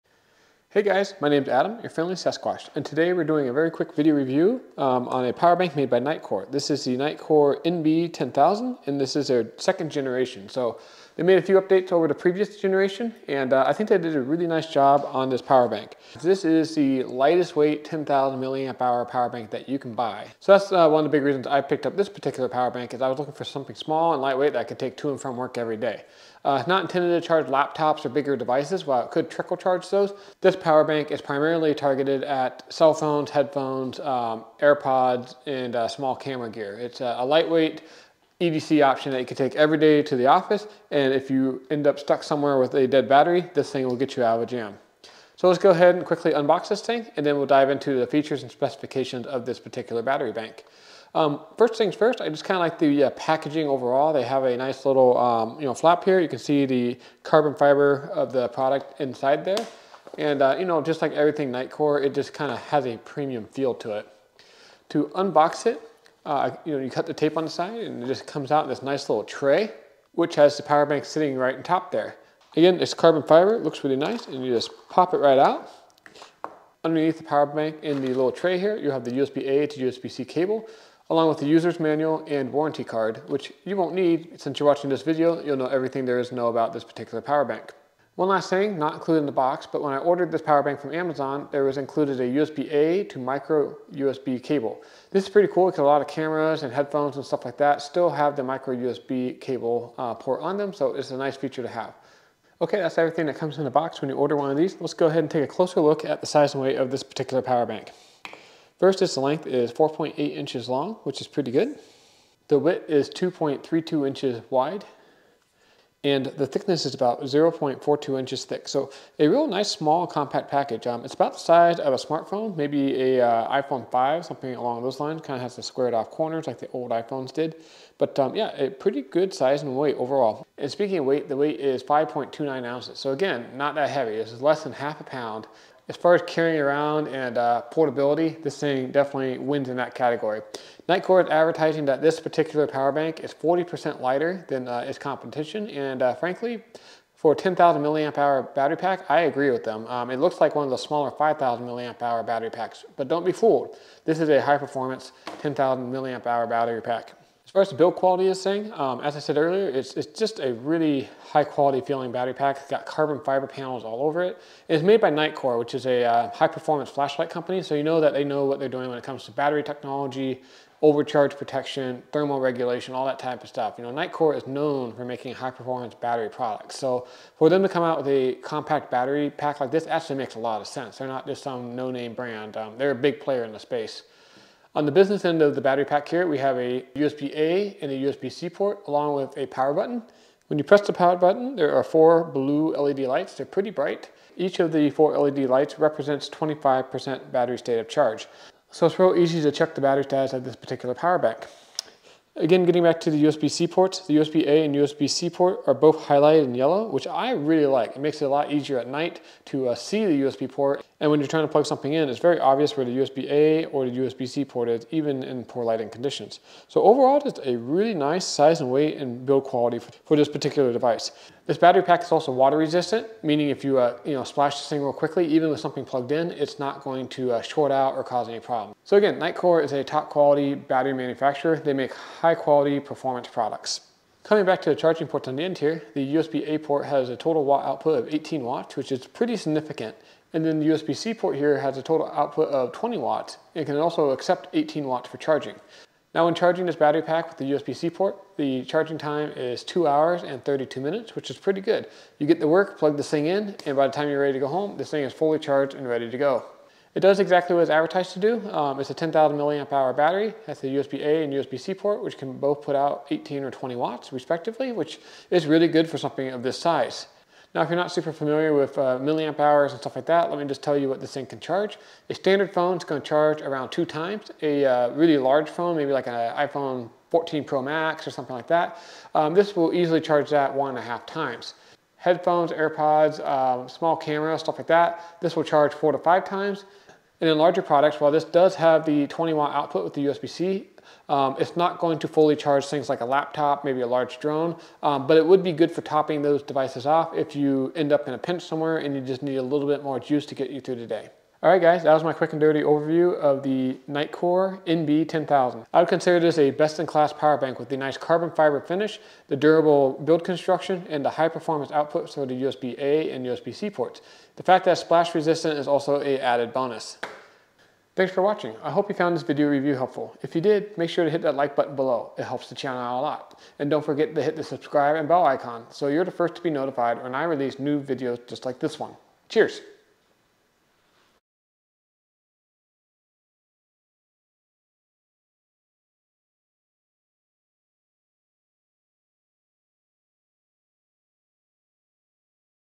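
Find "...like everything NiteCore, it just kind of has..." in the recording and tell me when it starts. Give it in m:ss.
1:01.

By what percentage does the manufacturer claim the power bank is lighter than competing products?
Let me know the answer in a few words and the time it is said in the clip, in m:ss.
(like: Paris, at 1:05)
40%, at 2:23.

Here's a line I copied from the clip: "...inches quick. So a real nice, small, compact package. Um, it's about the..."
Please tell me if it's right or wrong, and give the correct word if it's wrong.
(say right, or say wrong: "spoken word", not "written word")
wrong: "thick", not "quick".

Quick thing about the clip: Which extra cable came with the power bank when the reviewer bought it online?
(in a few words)
USB-A to micro USB.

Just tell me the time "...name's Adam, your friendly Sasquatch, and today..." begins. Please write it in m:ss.
0:01.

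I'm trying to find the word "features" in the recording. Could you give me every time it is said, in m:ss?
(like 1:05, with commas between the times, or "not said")
0:48, 1:41.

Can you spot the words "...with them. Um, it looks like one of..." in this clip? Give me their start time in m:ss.
2:29.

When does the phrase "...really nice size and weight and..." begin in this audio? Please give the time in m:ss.
3:37.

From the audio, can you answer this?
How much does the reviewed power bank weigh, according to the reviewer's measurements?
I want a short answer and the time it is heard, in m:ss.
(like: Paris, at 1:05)
5.29 ounces, at 2:11.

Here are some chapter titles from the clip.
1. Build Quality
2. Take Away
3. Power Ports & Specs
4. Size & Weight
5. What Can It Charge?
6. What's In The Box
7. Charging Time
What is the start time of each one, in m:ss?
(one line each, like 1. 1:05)
1. 2:37
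2. 5:01
3. 3:05
4. 1:45
5. 4:27
6. 0:46
7. 4:05.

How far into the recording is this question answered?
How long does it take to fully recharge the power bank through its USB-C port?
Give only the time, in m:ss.
4:09.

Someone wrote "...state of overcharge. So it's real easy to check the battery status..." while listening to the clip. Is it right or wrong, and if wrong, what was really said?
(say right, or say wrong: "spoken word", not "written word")
wrong: "charge", not "overcharge".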